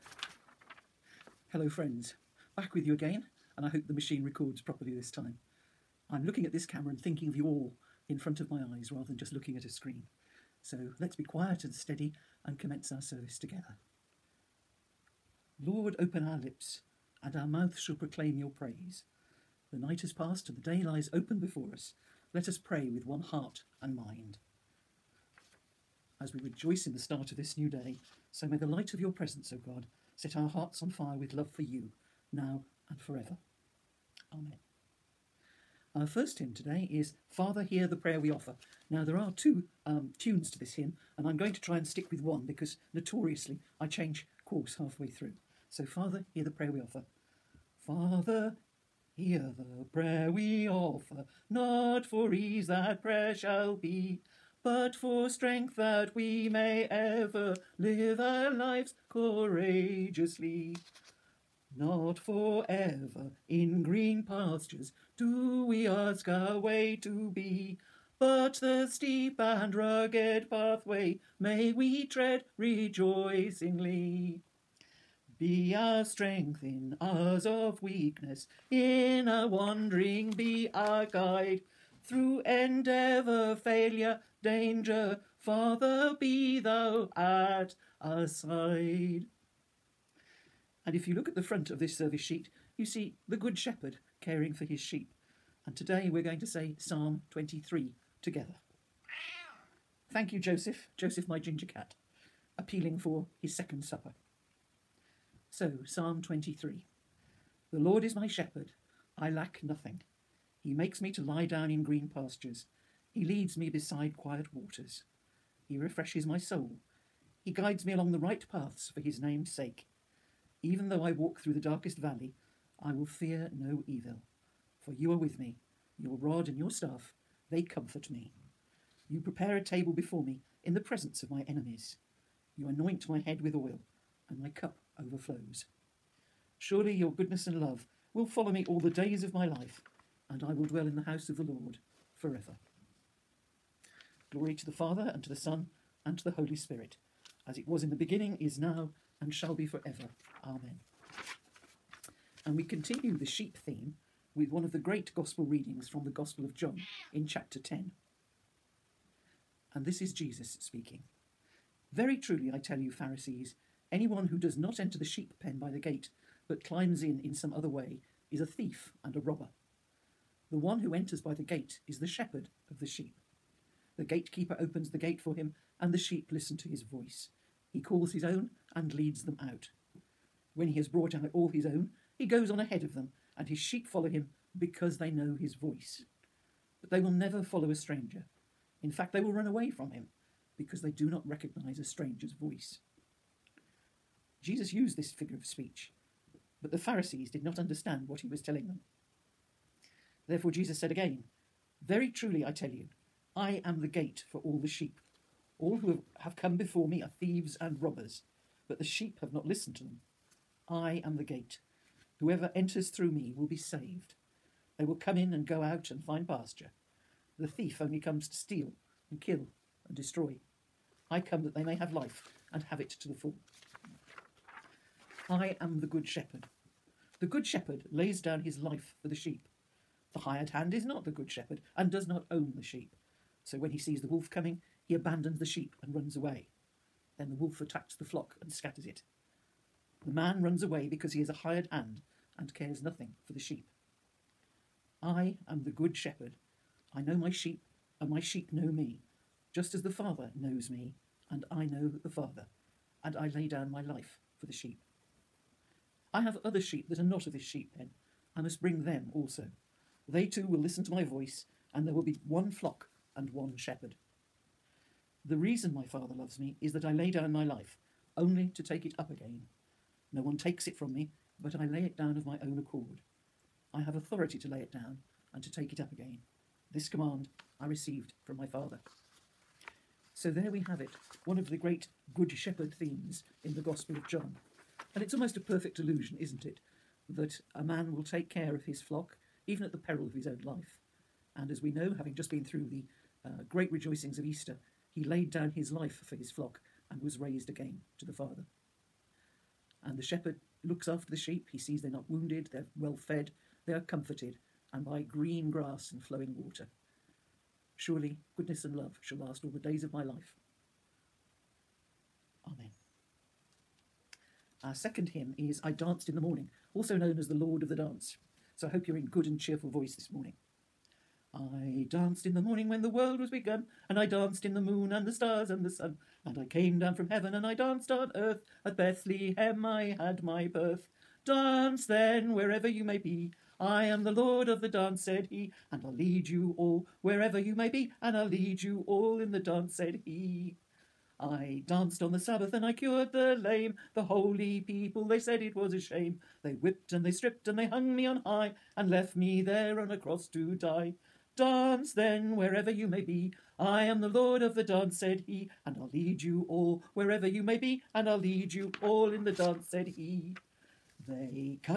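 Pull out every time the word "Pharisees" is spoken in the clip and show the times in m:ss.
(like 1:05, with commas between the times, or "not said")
2:42, 3:16.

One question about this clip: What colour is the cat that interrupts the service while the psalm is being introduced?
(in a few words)
Ginger.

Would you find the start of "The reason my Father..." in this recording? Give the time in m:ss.
4:25.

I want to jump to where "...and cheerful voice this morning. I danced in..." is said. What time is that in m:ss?
5:19.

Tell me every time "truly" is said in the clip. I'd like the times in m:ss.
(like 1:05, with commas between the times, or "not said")
2:42, 3:22.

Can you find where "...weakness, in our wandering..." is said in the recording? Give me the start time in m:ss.
1:17.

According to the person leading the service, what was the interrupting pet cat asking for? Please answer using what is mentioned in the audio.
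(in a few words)
His second supper.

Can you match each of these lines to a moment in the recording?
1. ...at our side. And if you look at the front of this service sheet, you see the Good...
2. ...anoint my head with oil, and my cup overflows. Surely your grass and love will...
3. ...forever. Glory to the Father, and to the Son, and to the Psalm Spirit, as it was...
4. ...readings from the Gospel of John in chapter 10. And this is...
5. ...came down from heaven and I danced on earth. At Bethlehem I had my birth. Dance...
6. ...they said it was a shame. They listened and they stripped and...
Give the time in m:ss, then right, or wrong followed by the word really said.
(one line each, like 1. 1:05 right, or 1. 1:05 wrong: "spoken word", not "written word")
1. 1:27 right
2. 2:12 wrong: "goodness", not "grass"
3. 2:22 wrong: "Holy", not "Psalm"
4. 2:35 right
5. 5:26 right
6. 5:45 wrong: "whipped", not "listened".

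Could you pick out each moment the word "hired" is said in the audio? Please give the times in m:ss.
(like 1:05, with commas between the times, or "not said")
3:50, 4:01.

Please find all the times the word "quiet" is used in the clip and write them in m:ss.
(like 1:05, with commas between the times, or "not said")
0:11, 1:54.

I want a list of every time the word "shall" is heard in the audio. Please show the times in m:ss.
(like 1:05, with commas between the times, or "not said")
0:17, 0:53, 2:29, 5:09.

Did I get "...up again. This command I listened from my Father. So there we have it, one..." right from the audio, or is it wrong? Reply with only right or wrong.
wrong.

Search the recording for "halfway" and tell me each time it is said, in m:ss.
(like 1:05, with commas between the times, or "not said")
0:44.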